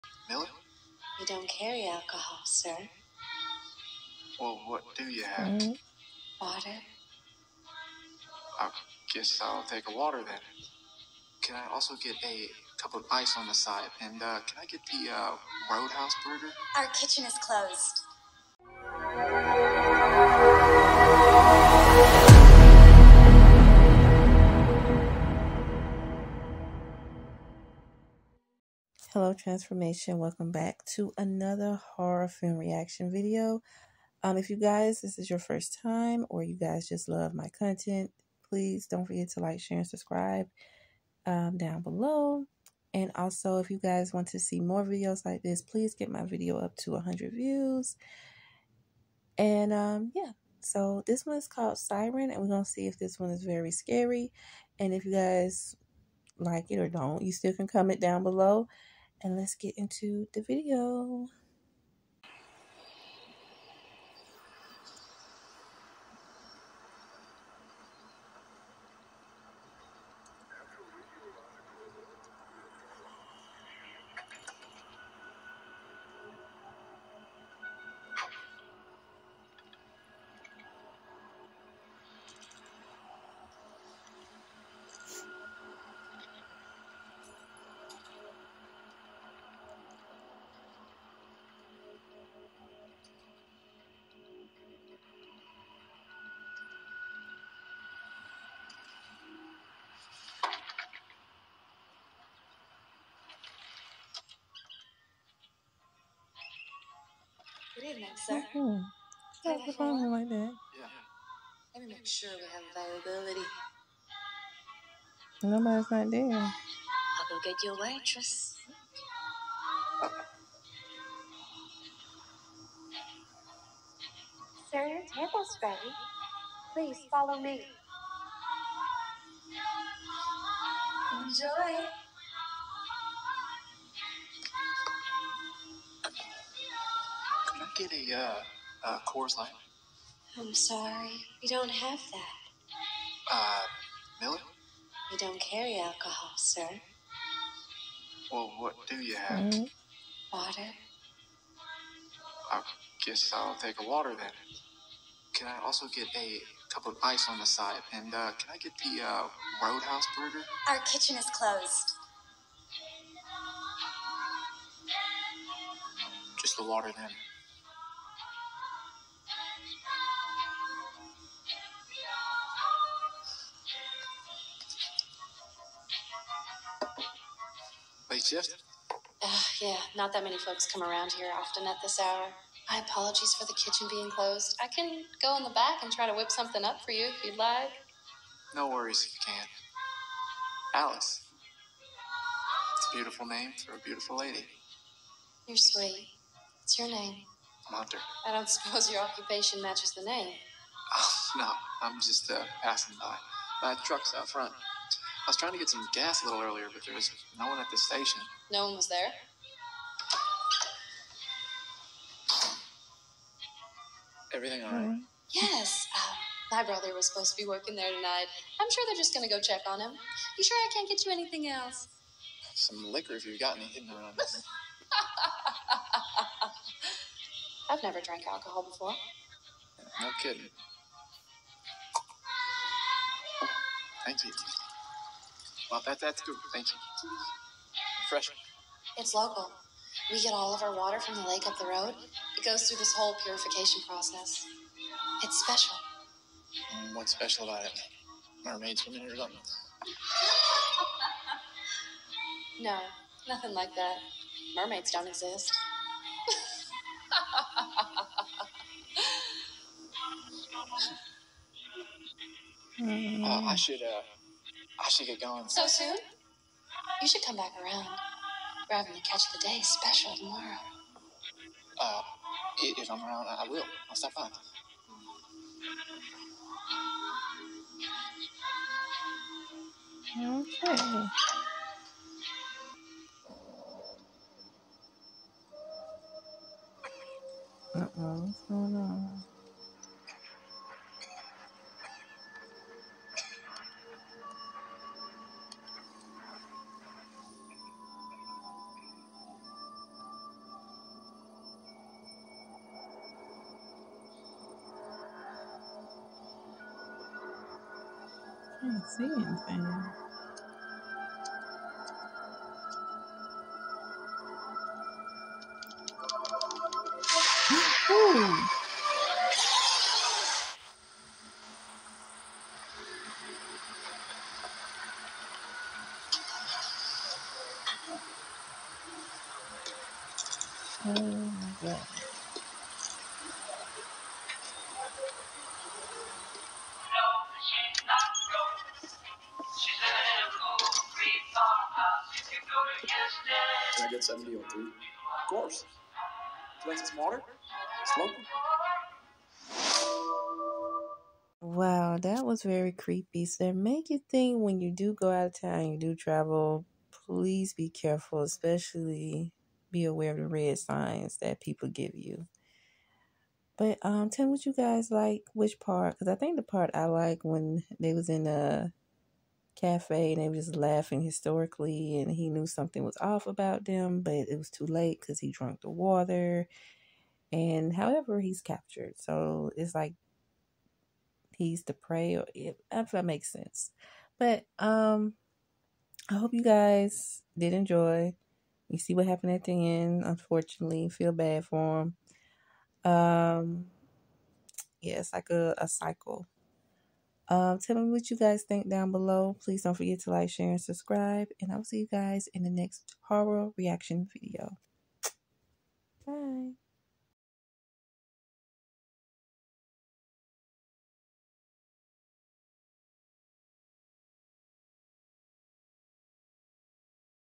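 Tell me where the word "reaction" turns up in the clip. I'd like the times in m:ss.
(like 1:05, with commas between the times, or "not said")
0:32, 6:43.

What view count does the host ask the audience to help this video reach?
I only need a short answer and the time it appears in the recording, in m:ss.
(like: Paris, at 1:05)
100, at 0:46.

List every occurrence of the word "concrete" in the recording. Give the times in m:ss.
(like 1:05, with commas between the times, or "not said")
not said.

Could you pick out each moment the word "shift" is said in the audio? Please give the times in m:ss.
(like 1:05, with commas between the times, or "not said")
2:58.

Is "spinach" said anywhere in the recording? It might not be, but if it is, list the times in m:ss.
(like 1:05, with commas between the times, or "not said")
not said.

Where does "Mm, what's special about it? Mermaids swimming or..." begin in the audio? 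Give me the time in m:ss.
4:06.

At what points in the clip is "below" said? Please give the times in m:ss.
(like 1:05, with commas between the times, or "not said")
0:41, 0:58, 6:38.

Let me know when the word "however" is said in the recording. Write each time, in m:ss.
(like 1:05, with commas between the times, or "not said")
6:17.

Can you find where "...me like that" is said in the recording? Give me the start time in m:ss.
1:50.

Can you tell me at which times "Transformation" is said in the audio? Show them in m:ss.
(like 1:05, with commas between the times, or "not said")
0:29.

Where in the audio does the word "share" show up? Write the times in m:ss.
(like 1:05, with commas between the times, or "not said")
0:39, 6:40.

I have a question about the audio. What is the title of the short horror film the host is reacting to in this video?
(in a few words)
Siren.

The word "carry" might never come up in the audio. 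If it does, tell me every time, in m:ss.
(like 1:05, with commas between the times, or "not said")
0:01, 2:25.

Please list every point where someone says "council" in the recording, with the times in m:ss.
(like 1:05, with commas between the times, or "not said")
not said.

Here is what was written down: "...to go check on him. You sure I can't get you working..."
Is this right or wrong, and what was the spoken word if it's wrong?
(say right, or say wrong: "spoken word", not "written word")
wrong: "anything", not "working".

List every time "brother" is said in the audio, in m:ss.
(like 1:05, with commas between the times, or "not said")
3:36.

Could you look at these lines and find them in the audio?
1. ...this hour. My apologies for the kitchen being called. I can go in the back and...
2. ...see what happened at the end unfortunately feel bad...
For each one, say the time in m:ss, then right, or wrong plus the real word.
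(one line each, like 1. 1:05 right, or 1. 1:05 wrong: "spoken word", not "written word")
1. 3:01 wrong: "closed", not "called"
2. 6:28 right.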